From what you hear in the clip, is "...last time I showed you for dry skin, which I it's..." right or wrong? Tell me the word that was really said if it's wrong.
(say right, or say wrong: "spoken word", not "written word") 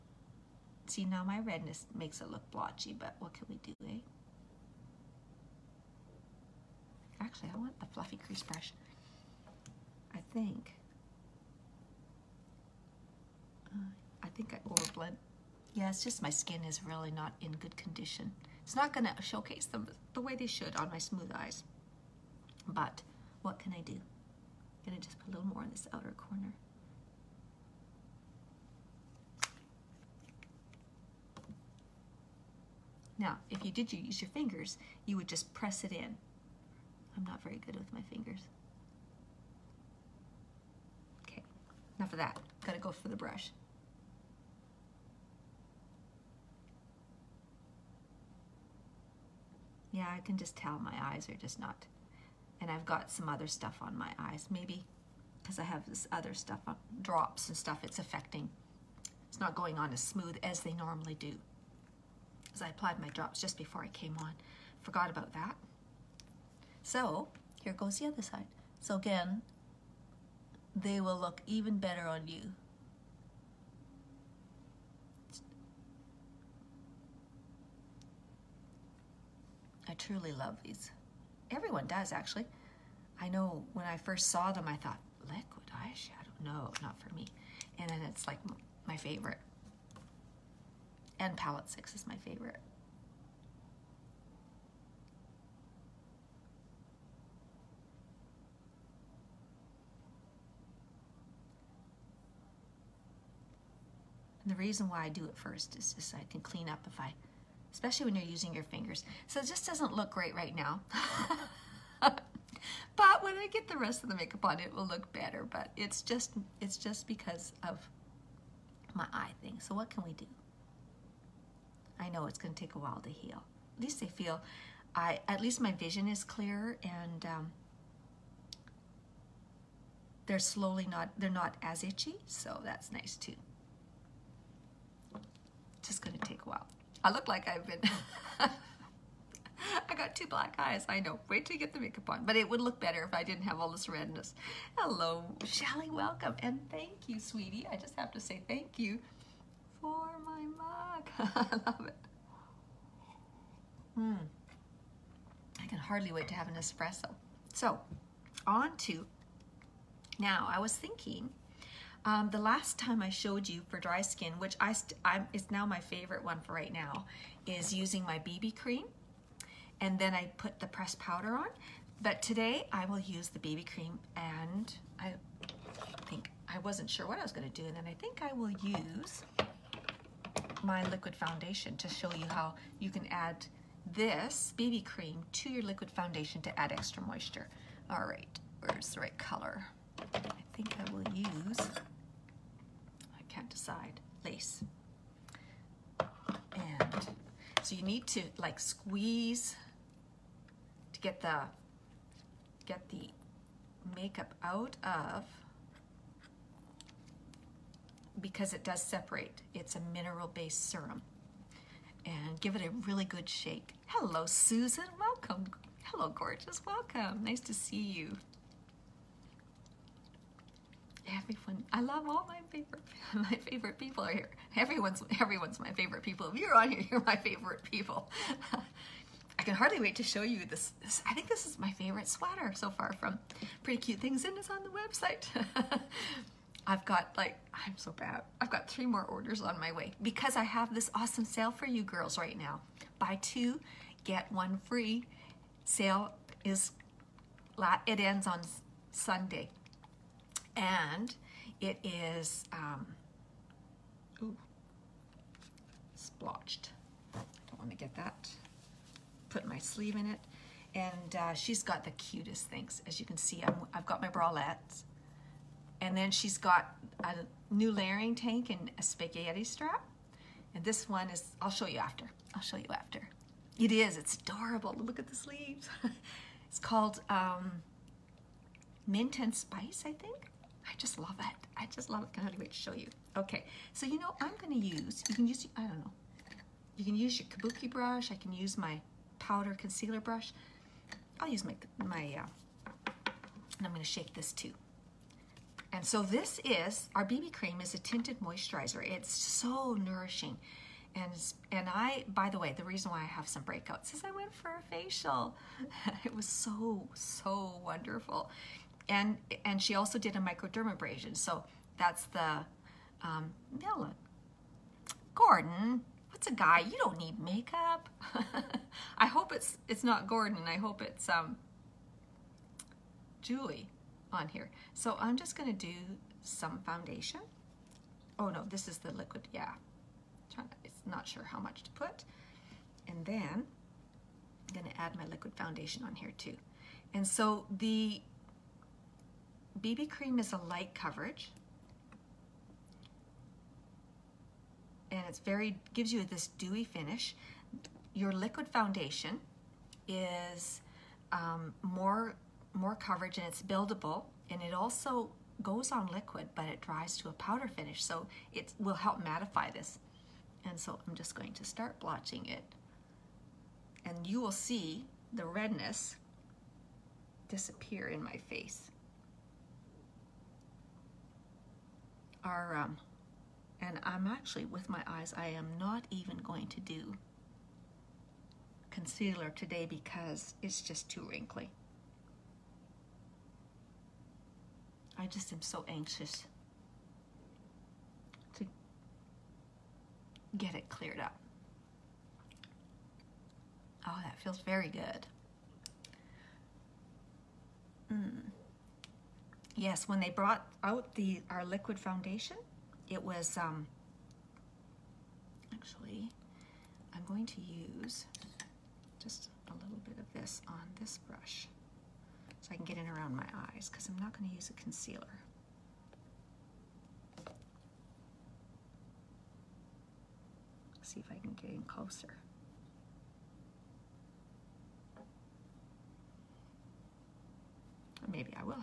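right.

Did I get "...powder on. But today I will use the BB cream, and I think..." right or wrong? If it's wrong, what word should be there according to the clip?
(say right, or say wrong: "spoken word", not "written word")
right.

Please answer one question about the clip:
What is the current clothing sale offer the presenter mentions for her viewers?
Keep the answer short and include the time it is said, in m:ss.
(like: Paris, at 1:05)
Buy two, get one free, at 4:02.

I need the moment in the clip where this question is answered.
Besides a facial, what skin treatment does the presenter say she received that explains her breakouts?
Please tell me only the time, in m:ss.
5:10.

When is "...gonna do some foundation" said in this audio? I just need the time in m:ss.
5:25.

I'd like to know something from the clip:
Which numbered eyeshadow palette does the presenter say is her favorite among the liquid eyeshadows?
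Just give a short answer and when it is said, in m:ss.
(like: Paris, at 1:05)
palette 6, at 1:31.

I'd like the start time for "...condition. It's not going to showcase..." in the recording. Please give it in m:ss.
0:17.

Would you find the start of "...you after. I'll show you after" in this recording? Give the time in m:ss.
4:31.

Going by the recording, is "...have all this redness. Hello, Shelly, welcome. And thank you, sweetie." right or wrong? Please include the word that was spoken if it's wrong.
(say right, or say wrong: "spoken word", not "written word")
right.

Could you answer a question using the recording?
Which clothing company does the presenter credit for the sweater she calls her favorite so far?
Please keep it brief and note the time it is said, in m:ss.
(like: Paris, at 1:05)
Pretty Cute Things, at 3:53.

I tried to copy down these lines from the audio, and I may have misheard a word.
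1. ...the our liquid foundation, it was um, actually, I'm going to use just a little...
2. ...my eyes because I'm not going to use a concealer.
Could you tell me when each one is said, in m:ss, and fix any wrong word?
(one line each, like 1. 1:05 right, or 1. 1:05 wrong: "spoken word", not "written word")
1. 6:40 right
2. 6:53 right.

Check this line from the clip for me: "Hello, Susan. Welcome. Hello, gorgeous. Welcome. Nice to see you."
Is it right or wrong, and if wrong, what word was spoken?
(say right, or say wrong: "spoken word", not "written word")
right.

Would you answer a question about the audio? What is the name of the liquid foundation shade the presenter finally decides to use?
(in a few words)
Lace.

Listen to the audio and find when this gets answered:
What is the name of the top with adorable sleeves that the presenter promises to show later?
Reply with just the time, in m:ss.
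4:38.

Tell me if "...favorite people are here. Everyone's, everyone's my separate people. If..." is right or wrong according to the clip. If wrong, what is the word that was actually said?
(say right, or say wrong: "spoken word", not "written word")
wrong: "favorite", not "separate".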